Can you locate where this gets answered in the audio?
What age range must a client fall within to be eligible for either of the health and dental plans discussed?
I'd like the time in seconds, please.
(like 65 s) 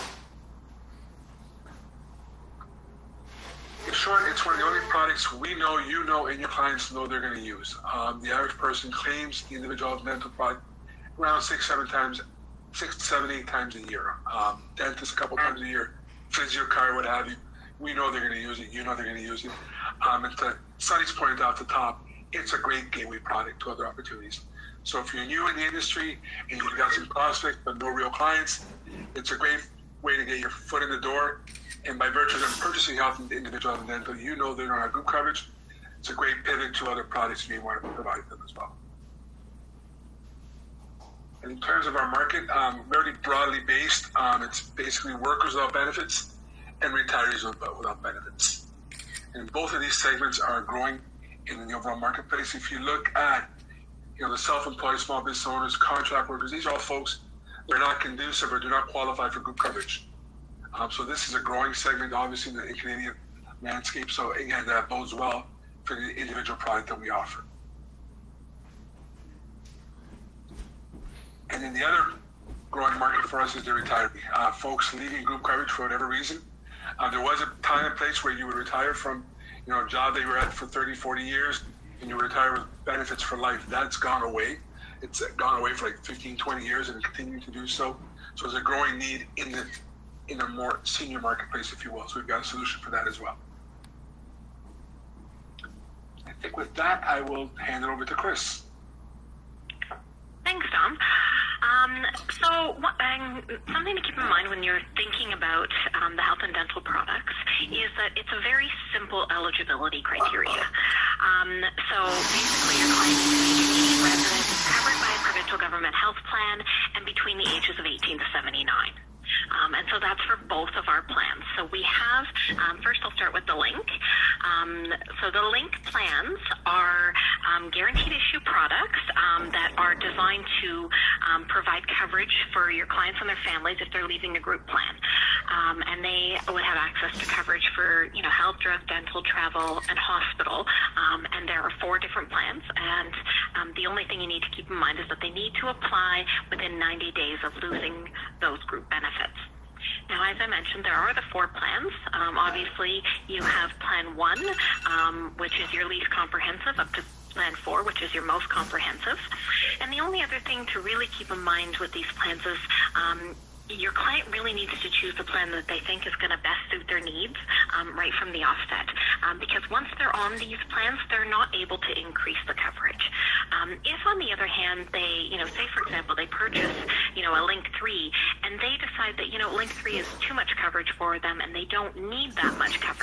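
117 s.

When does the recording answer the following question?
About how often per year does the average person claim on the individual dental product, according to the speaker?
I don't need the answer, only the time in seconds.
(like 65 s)
11 s.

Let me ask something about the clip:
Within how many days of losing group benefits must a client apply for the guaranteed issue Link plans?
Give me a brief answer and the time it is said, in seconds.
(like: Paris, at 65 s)
90 days, at 146 s.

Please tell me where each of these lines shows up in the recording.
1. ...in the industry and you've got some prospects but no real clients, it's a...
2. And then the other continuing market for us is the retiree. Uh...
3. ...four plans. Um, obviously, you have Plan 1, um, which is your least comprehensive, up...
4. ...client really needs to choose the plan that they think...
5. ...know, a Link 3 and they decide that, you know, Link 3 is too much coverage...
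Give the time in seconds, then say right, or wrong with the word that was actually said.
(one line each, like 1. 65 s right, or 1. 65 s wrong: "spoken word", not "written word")
1. 25 s right
2. 71 s wrong: "growing", not "continuing"
3. 151 s right
4. 163 s right
5. 177 s right.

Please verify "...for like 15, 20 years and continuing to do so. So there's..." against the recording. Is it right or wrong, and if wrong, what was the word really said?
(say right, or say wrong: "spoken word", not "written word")
right.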